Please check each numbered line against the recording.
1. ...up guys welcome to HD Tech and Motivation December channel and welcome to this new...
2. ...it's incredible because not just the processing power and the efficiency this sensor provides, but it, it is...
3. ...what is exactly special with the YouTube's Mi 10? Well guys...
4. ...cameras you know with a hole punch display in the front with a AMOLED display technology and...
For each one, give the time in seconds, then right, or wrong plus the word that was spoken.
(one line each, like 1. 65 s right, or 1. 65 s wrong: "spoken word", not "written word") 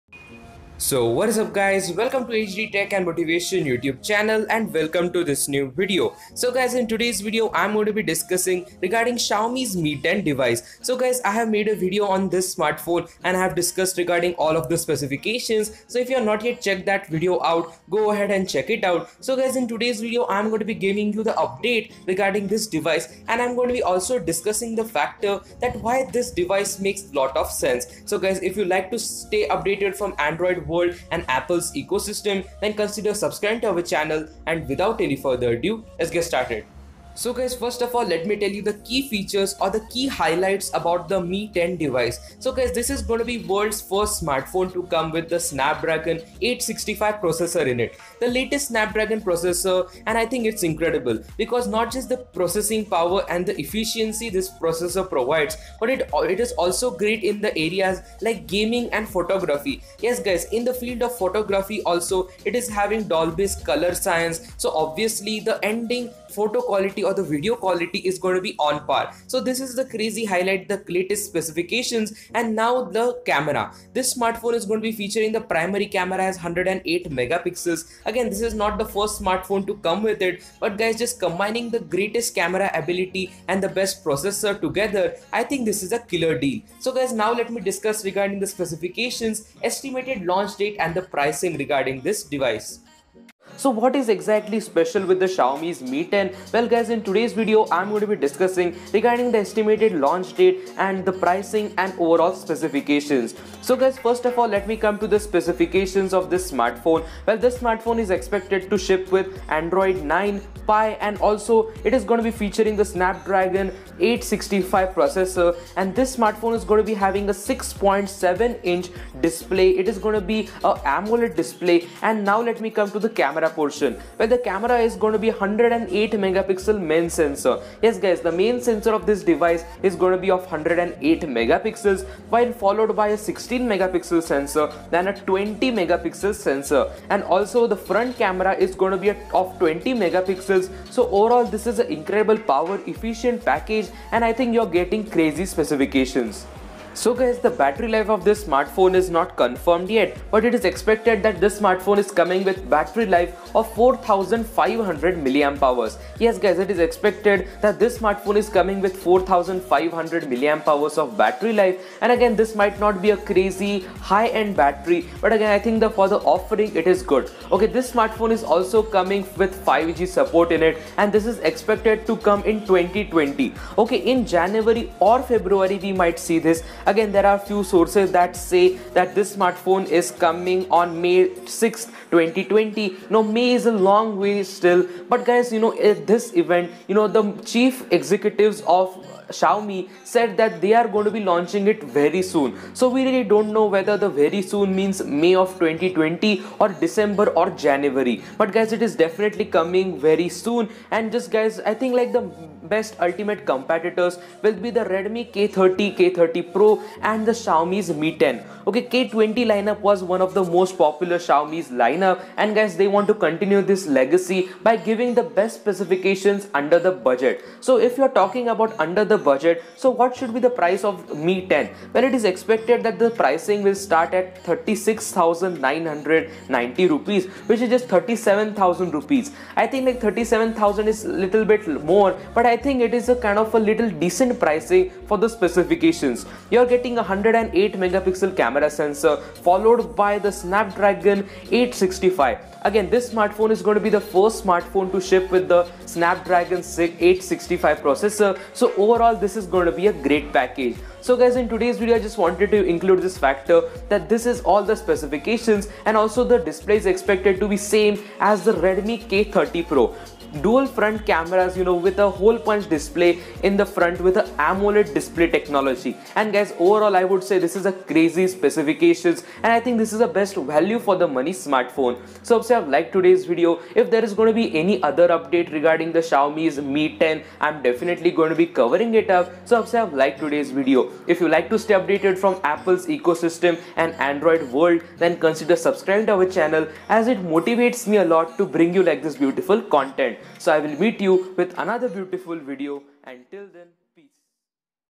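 1. 1 s wrong: "YouTube", not "December"
2. 50 s wrong: "processor", not "sensor"
3. 93 s wrong: "Xiaomi", not "YouTube"
4. 261 s right.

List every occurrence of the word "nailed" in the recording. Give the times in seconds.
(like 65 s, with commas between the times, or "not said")
not said.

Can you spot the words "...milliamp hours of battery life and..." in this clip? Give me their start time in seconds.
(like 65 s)
160 s.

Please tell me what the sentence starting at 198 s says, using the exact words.
But guys, it is definitely coming very soon.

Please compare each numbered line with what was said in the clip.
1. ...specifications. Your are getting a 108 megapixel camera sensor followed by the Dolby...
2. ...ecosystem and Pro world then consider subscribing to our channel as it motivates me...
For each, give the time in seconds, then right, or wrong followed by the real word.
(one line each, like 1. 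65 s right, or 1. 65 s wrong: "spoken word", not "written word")
1. 235 s wrong: "Snapdragon", not "Dolby"
2. 282 s wrong: "Android", not "Pro".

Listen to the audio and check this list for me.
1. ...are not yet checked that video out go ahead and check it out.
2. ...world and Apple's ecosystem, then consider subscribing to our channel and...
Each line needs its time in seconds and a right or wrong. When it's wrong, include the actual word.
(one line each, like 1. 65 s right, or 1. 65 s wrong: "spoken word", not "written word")
1. 16 s right
2. 30 s right.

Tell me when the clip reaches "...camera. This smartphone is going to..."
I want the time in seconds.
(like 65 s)
73 s.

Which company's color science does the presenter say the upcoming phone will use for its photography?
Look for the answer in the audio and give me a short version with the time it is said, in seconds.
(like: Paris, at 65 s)
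Dolby, at 63 s.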